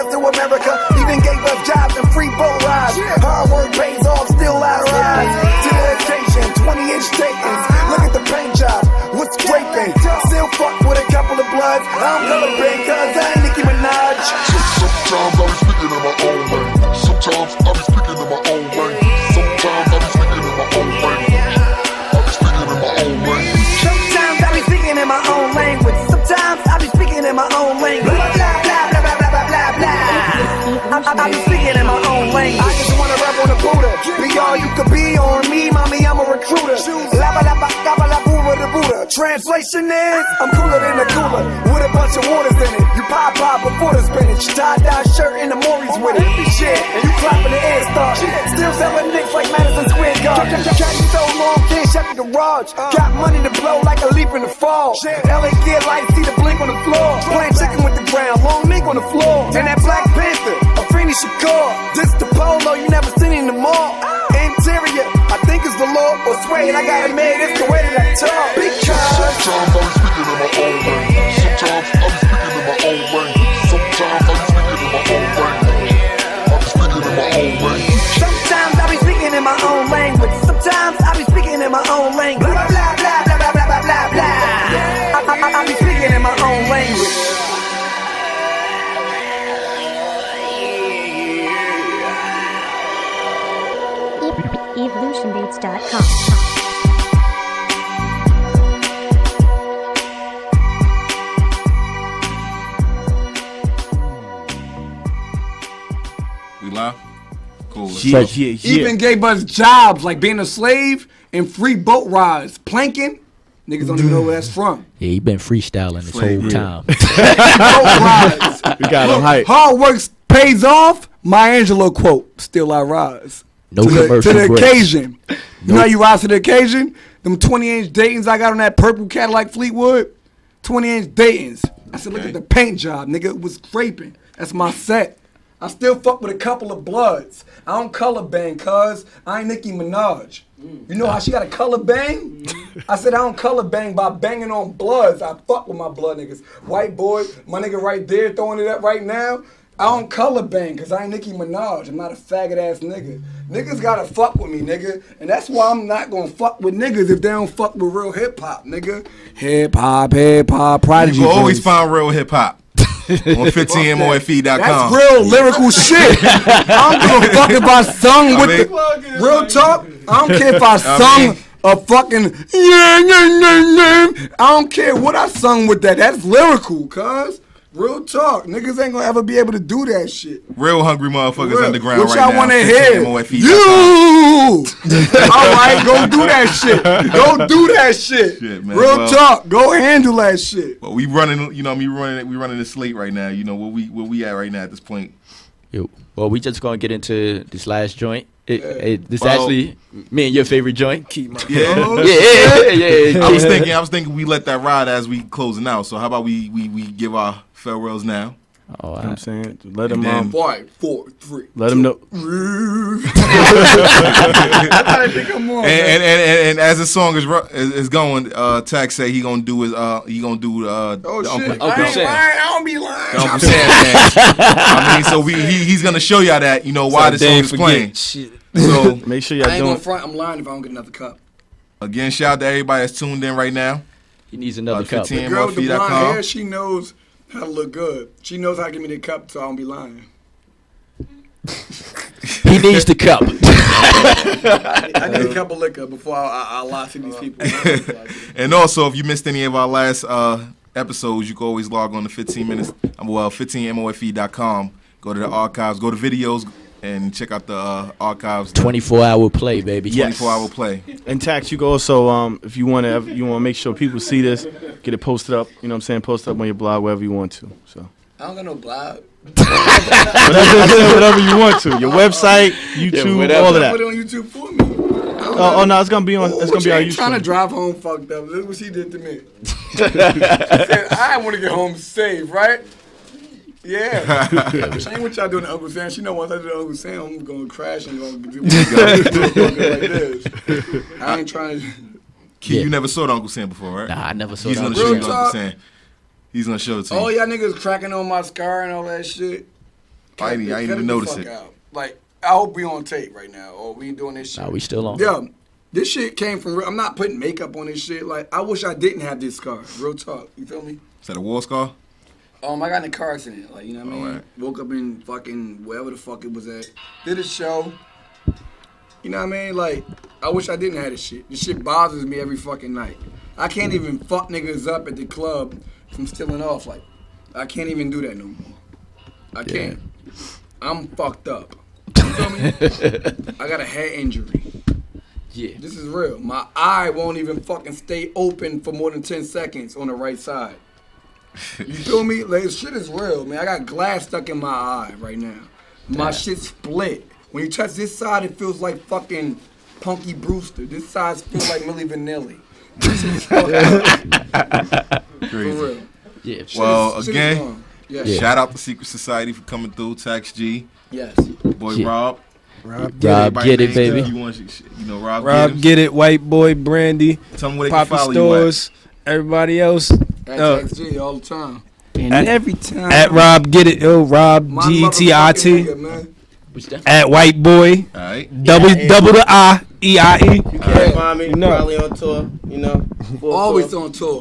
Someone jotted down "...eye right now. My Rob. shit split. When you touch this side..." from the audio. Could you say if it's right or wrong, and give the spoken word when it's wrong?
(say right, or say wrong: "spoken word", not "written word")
wrong: "Damn", not "Rob".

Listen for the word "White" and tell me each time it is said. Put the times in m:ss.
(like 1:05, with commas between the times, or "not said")
2:26, 6:05, 6:17.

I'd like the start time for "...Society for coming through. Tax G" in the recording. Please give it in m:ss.
5:58.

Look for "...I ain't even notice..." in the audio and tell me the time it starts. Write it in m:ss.
5:00.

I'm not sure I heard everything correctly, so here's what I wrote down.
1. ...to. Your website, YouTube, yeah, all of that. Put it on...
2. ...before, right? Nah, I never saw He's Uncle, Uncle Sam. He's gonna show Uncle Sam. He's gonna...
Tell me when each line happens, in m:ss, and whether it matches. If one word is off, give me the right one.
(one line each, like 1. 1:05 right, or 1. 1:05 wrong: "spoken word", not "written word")
1. 4:31 right
2. 4:53 right.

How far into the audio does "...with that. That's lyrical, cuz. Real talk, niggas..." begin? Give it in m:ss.
2:55.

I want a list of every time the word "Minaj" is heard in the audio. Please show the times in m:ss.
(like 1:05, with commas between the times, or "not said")
2:19, 2:31.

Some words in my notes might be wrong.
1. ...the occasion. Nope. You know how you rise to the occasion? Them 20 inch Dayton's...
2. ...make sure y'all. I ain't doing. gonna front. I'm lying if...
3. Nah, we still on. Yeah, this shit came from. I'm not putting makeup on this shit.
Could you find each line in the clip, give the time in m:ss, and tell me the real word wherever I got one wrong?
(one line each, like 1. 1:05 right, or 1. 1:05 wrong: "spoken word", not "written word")
1. 2:04 right
2. 3:49 right
3. 5:04 right.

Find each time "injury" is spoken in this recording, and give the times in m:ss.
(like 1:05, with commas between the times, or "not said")
5:33.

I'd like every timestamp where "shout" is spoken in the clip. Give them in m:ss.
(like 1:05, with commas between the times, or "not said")
3:52, 5:58.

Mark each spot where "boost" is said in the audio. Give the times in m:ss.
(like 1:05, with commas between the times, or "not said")
not said.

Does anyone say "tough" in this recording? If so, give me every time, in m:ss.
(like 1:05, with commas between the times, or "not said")
not said.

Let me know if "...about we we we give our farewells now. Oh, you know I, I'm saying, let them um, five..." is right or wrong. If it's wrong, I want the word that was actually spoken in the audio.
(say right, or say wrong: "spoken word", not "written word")
right.